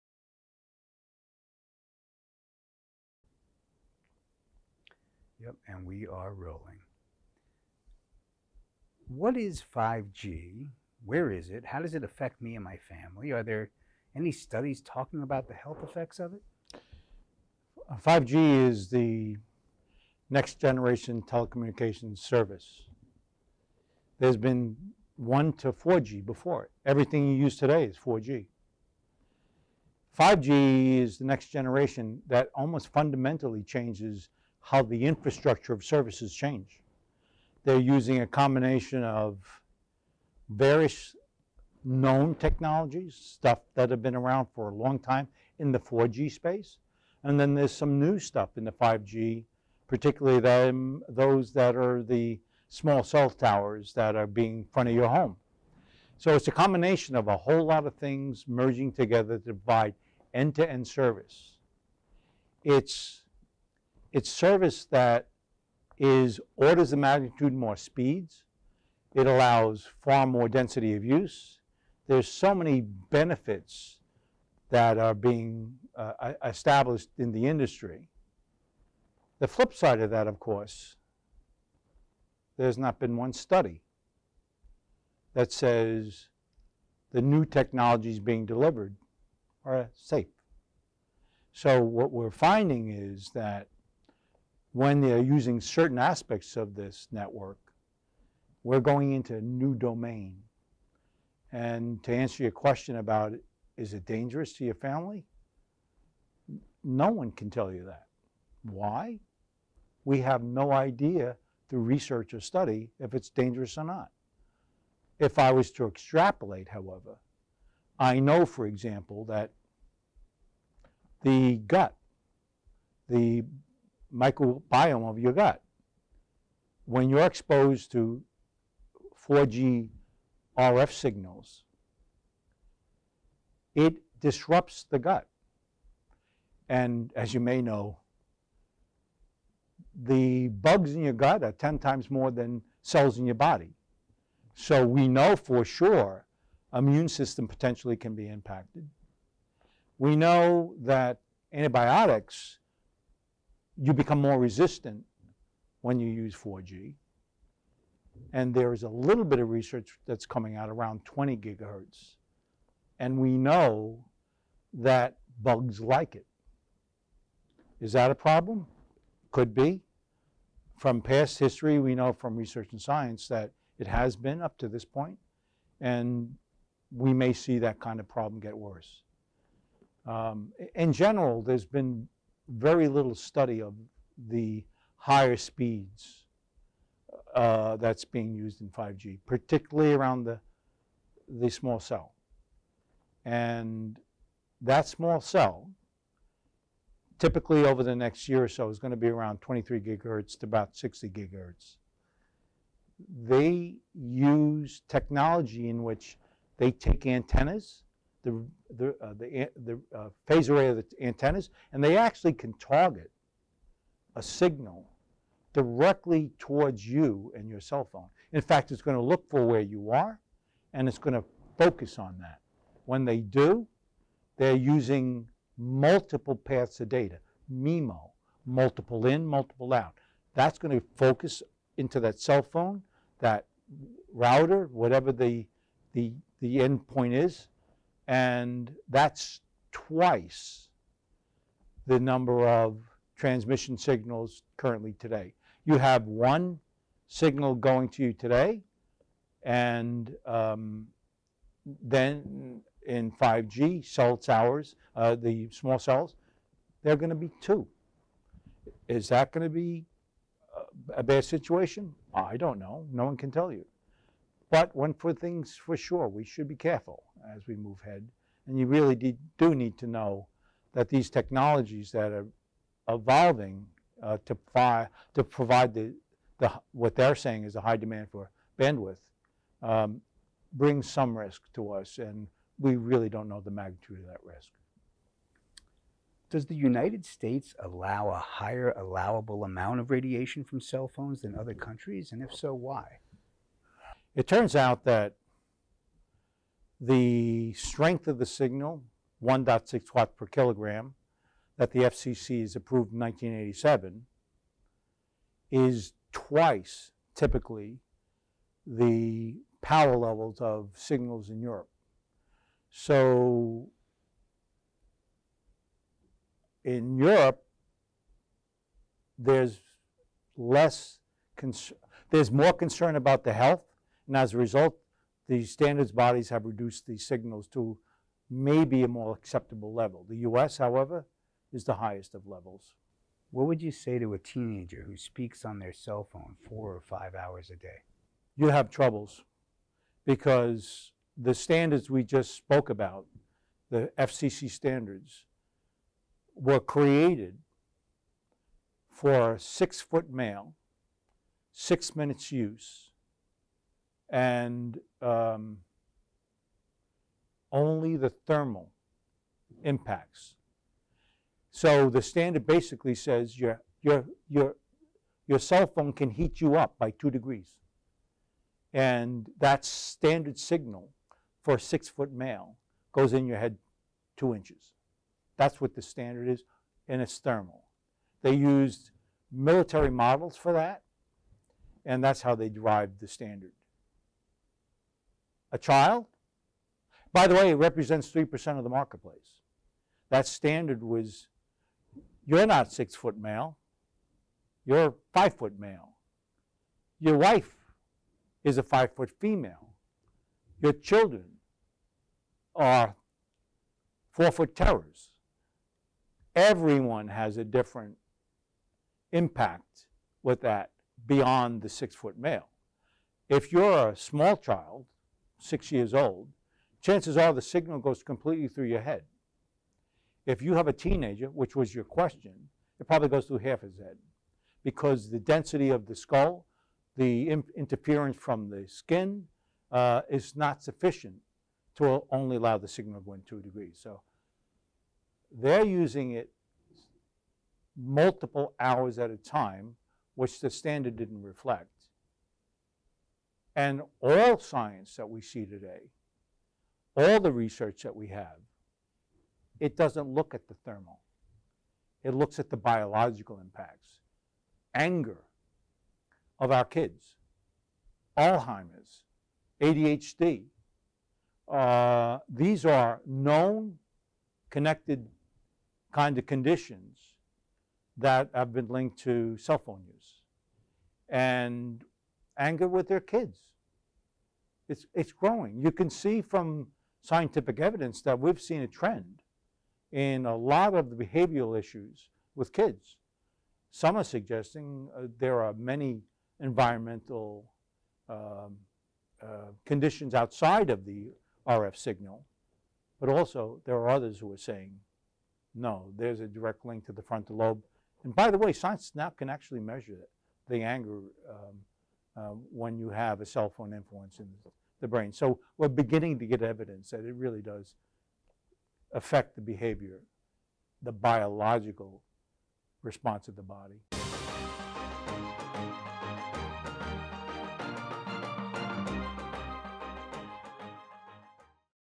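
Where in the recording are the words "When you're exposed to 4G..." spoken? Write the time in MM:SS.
02:06.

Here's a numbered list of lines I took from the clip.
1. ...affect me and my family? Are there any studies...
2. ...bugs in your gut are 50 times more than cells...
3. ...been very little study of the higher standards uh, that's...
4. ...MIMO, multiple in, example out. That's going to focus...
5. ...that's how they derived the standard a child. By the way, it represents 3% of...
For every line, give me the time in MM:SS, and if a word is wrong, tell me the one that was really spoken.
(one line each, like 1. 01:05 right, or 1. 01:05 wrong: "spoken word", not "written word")
1. 00:12 right
2. 02:20 wrong: "10", not "50"
3. 03:01 wrong: "speeds", not "standards"
4. 03:47 wrong: "multiple", not "example"
5. 06:22 right.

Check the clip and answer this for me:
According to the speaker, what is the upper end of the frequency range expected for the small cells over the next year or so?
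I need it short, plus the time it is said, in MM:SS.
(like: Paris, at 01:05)
60 gigahertz, at 03:20.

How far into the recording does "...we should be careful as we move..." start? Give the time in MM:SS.
04:26.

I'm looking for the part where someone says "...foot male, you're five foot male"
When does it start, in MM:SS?
06:32.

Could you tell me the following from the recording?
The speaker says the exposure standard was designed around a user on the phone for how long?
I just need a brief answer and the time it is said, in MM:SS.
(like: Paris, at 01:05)
six minutes, at 05:51.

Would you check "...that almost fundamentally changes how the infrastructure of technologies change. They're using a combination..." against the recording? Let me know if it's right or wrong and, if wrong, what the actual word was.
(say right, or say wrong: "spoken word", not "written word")
wrong: "services", not "technologies".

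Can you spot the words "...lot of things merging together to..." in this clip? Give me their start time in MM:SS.
00:57.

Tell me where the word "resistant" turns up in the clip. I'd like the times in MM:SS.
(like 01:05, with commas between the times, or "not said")
02:34.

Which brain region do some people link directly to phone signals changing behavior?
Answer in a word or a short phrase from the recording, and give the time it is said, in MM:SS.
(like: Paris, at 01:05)
frontal lobe, at 08:17.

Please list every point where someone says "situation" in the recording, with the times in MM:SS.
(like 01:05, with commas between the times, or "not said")
04:21.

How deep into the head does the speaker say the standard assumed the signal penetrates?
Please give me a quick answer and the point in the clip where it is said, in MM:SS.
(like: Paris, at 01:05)
two inches, at 06:14.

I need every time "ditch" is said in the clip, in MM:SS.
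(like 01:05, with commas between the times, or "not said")
not said.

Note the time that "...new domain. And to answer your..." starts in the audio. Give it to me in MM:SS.
01:39.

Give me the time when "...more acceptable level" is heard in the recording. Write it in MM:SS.
05:28.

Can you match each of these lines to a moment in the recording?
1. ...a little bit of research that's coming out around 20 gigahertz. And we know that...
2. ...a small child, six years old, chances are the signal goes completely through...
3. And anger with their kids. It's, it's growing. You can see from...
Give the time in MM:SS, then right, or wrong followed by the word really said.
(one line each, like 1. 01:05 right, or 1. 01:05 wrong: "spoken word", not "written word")
1. 02:38 right
2. 06:53 right
3. 07:51 right.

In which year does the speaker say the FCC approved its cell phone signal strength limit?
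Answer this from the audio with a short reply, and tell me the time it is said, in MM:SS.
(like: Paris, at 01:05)
1987, at 05:02.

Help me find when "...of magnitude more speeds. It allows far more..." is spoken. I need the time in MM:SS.
01:06.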